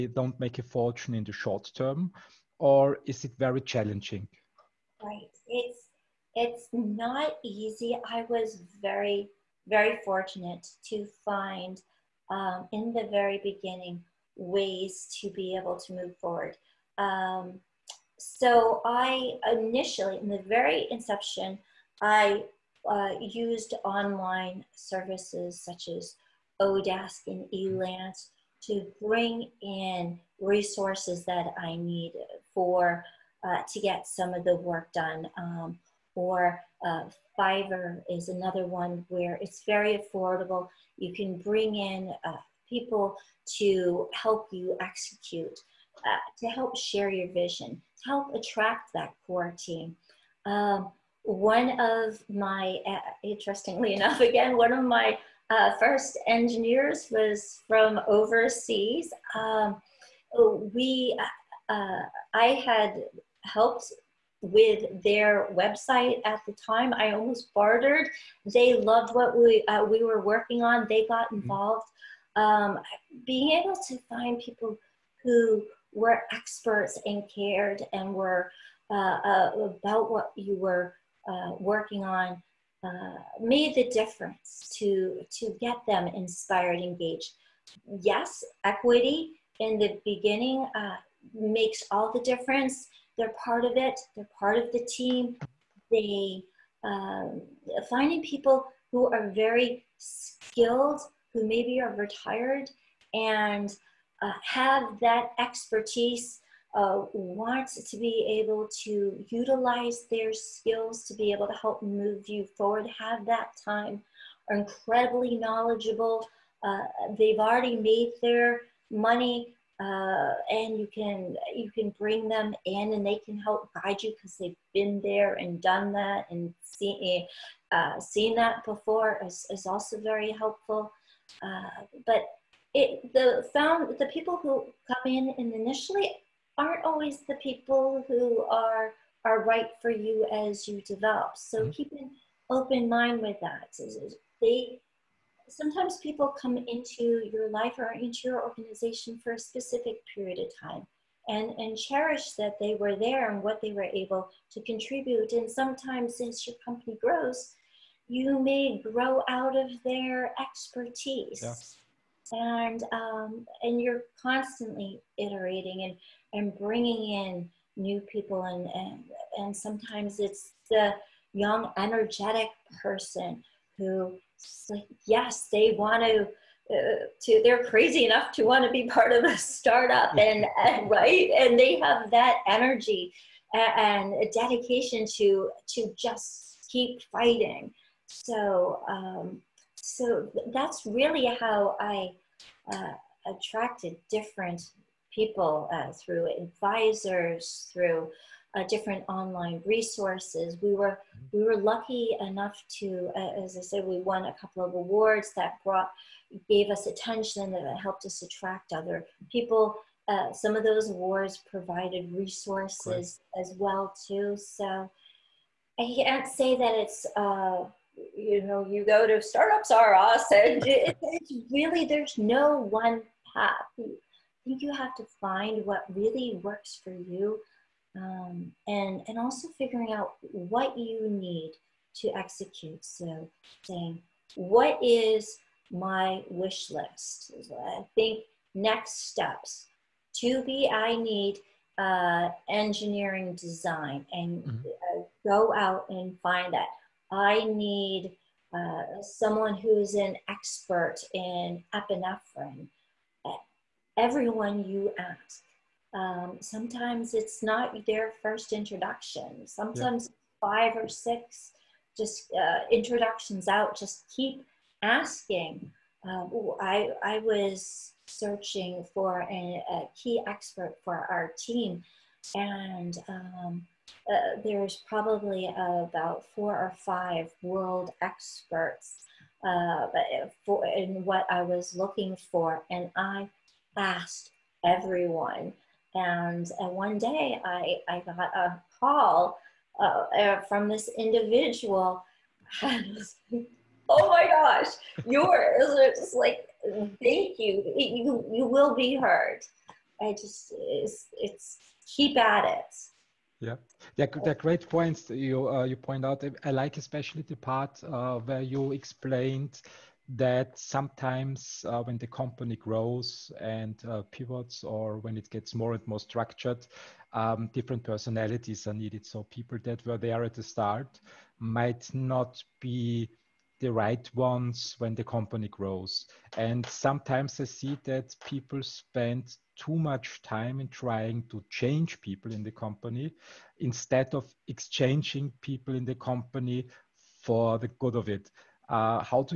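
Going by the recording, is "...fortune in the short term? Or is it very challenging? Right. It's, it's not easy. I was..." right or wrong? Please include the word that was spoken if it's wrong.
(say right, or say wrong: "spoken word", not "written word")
right.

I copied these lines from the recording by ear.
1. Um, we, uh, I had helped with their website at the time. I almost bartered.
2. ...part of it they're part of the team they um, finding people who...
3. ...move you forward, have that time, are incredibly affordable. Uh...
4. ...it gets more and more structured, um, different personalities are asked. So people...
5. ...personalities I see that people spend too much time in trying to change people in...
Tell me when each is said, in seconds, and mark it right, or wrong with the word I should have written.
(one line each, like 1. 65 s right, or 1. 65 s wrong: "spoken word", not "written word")
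1. 59 s right
2. 93 s right
3. 111 s wrong: "knowledgeable", not "affordable"
4. 315 s wrong: "needed", not "asked"
5. 326 s wrong: "sometimes", not "personalities".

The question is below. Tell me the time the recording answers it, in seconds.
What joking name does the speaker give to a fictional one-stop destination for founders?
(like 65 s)
219 s.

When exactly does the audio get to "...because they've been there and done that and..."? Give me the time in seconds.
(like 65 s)
124 s.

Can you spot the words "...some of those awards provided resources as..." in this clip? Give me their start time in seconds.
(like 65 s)
210 s.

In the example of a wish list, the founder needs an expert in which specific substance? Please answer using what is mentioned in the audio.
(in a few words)
epinephrine.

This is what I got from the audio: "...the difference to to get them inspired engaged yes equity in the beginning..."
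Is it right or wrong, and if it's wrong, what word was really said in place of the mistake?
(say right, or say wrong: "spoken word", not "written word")
right.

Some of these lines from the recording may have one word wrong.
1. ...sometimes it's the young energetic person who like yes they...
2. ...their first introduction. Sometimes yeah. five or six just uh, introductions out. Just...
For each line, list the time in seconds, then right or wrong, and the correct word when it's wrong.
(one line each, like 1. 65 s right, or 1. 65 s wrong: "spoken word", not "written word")
1. 169 s right
2. 257 s right.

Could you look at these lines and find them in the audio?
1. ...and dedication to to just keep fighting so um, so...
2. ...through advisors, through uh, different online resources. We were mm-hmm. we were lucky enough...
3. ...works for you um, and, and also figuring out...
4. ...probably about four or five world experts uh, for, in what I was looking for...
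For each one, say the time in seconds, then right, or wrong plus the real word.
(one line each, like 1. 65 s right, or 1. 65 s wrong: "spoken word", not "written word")
1. 184 s right
2. 195 s right
3. 226 s right
4. 274 s right.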